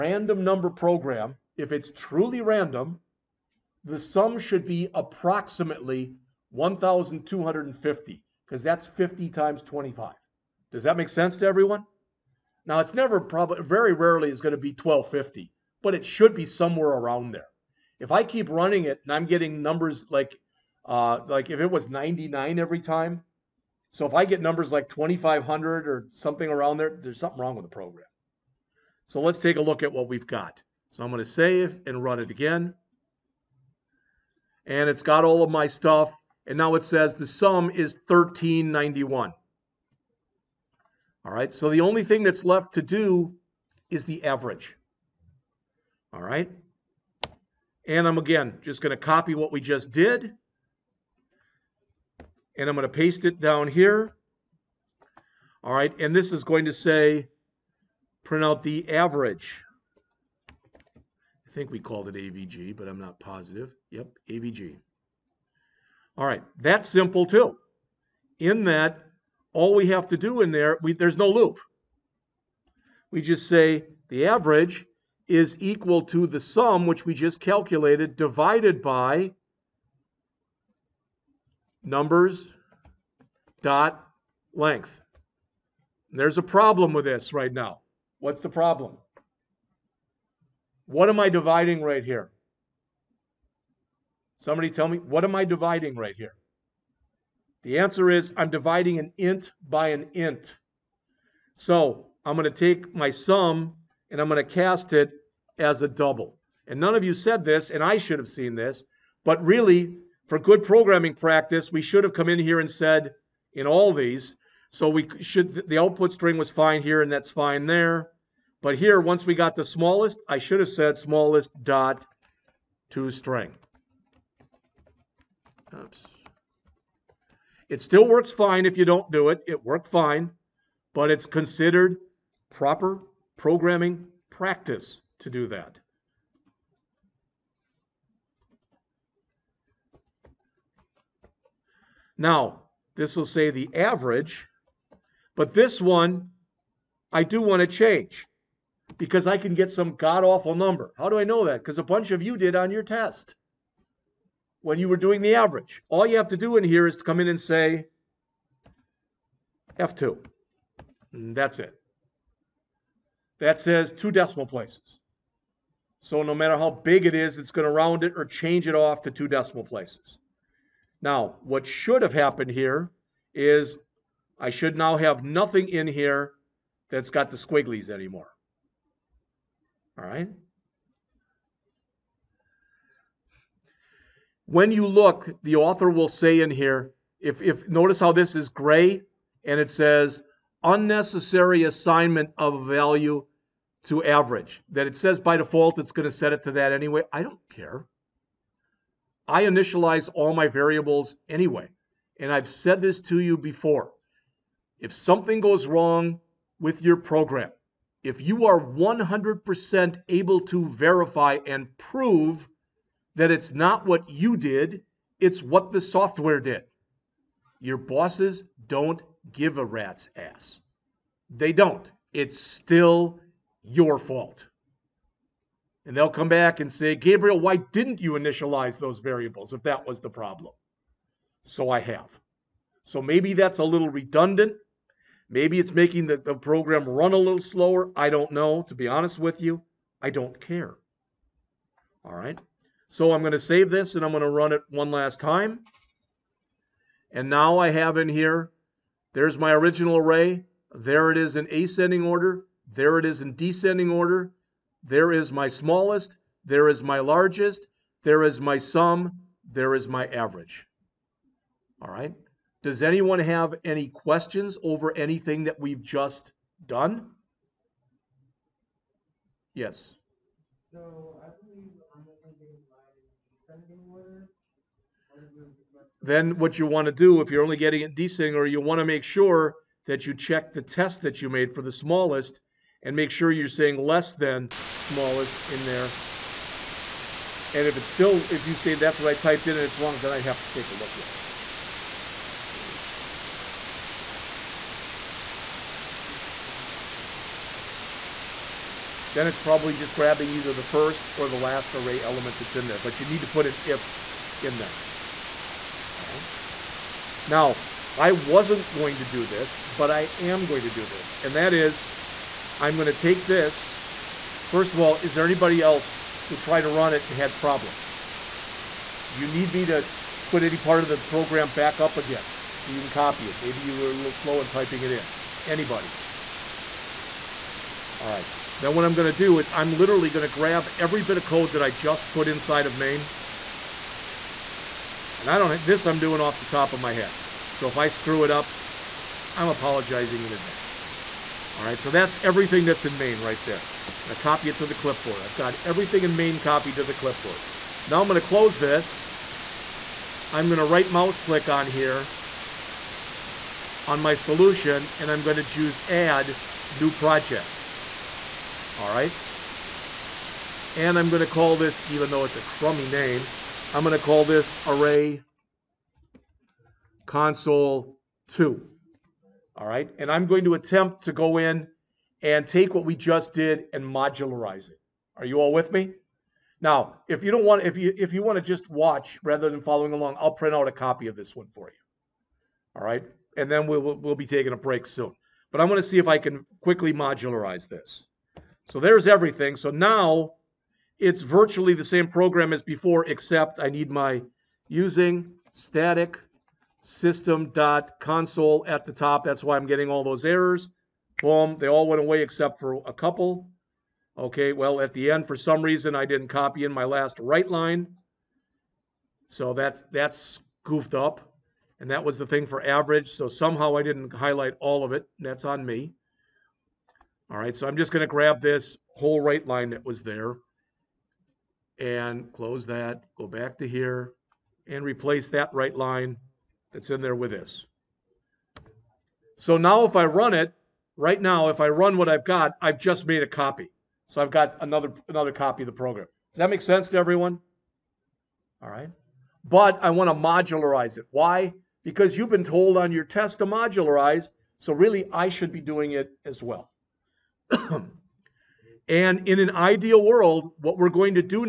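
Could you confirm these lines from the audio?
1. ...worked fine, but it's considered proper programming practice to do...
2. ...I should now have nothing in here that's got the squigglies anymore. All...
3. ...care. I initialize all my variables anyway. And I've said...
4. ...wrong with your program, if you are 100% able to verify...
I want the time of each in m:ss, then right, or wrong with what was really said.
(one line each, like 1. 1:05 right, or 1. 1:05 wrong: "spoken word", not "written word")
1. 2:09 right
2. 2:54 right
3. 3:17 right
4. 3:25 right.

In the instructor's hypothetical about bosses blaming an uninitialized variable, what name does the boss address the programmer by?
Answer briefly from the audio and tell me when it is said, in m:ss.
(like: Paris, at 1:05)
Gabriel, at 3:46.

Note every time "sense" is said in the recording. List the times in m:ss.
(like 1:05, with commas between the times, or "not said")
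0:11, 7:16.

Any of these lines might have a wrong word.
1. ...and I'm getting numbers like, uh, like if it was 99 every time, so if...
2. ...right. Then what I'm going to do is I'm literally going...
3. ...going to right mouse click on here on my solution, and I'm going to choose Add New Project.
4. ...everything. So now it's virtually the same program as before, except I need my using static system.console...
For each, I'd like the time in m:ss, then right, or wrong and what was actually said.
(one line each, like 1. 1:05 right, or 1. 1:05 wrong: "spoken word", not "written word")
1. 0:19 right
2. 5:28 right
3. 5:50 right
4. 6:29 right.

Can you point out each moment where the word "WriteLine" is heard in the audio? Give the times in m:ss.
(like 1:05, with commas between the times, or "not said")
6:47, 6:59.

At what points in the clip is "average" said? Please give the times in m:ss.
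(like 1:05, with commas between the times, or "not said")
0:44, 0:58, 1:14, 2:23, 2:35, 3:14, 4:20, 6:52.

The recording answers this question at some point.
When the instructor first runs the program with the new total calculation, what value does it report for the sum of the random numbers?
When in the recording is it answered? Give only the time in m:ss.
0:38.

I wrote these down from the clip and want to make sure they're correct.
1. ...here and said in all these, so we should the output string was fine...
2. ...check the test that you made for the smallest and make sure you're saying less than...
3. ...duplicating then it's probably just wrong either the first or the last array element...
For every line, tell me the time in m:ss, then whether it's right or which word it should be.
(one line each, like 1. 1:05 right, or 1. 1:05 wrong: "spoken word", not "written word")
1. 1:52 right
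2. 4:40 right
3. 4:56 wrong: "grabbing", not "wrong".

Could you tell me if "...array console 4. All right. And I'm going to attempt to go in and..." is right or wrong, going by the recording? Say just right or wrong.
wrong.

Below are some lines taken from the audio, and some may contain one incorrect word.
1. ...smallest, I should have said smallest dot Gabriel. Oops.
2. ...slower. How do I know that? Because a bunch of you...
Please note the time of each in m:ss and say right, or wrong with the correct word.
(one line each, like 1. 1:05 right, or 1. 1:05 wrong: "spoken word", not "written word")
1. 1:59 wrong: "ToString", not "Gabriel"
2. 2:30 wrong: "number", not "slower".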